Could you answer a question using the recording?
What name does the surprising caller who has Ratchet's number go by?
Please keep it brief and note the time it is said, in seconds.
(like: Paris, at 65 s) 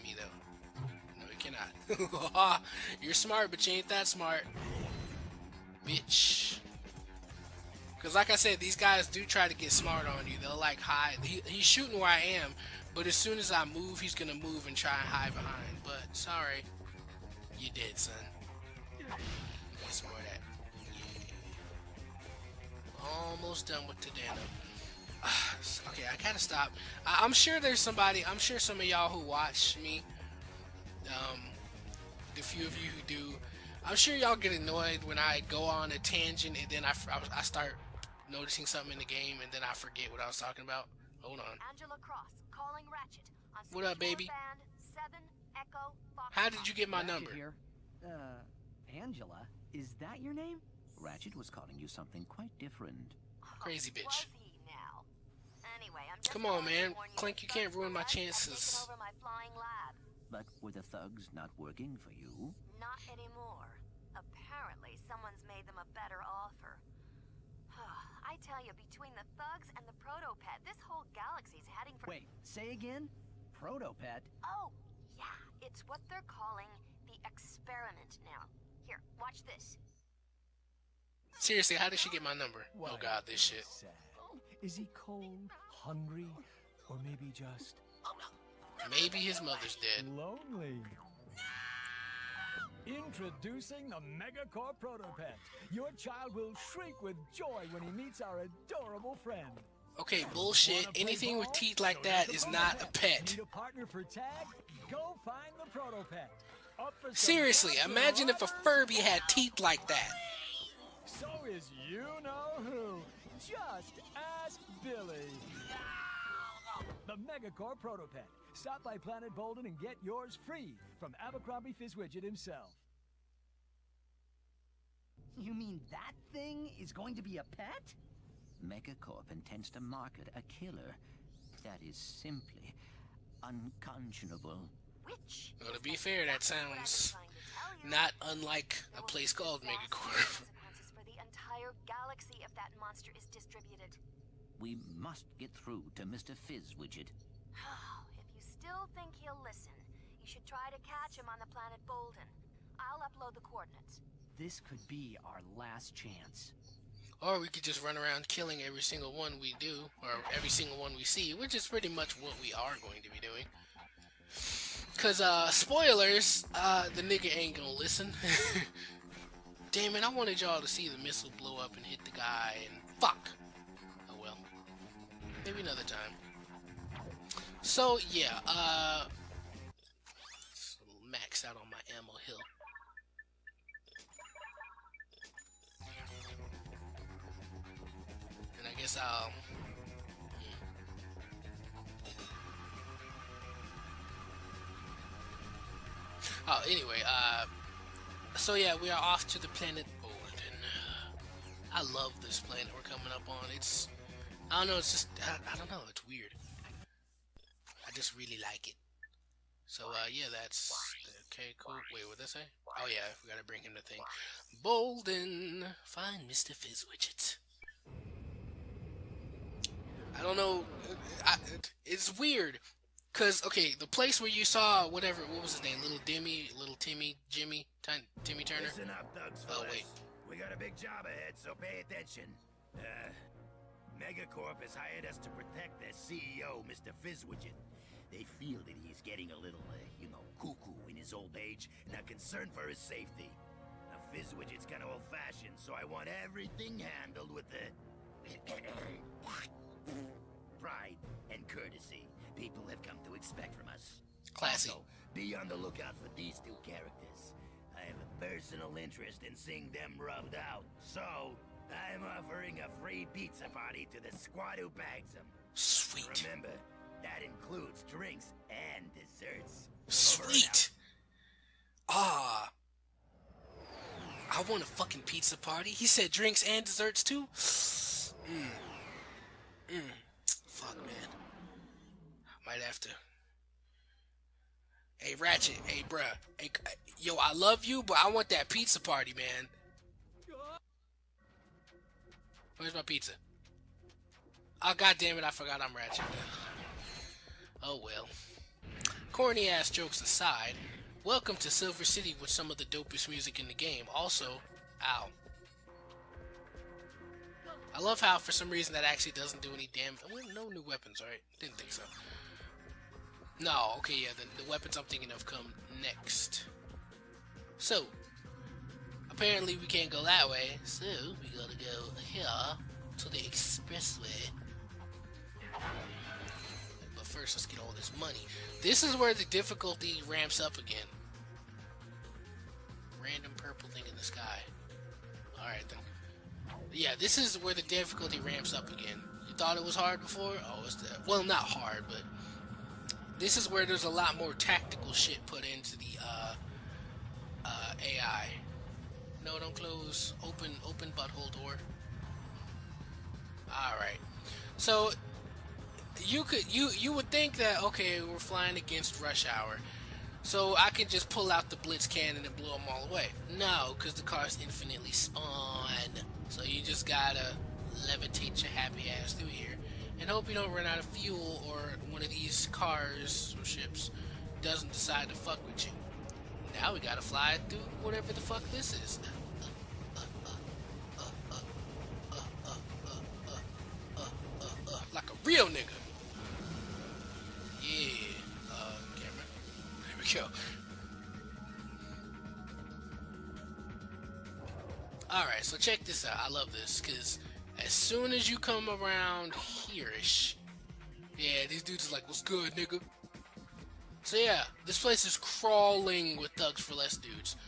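Angela Cross, at 41 s.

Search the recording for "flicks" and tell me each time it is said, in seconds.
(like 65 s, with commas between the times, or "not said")
not said.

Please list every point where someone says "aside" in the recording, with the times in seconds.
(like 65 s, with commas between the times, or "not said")
299 s.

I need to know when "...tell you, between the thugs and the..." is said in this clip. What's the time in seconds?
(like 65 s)
68 s.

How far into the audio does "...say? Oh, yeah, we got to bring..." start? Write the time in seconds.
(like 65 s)
212 s.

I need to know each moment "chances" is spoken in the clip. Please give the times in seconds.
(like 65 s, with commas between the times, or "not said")
58 s, 155 s.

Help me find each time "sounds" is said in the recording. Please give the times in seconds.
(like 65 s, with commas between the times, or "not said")
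136 s.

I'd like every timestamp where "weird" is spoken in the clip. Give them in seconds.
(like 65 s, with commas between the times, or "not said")
206 s, 222 s.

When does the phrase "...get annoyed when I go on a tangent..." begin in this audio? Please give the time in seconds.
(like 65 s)
34 s.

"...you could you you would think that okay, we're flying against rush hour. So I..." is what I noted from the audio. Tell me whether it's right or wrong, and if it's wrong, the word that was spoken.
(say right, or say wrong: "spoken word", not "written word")
right.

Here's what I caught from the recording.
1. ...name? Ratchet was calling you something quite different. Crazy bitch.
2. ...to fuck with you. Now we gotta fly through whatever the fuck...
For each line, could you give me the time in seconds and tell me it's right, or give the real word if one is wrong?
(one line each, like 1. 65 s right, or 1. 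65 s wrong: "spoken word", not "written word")
1. 50 s right
2. 375 s right.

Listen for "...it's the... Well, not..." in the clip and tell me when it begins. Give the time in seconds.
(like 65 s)
340 s.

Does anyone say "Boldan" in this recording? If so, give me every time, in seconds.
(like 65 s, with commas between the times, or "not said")
119 s, 151 s, 214 s.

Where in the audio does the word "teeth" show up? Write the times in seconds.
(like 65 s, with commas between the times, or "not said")
101 s, 109 s.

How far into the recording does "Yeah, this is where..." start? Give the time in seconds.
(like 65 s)
336 s.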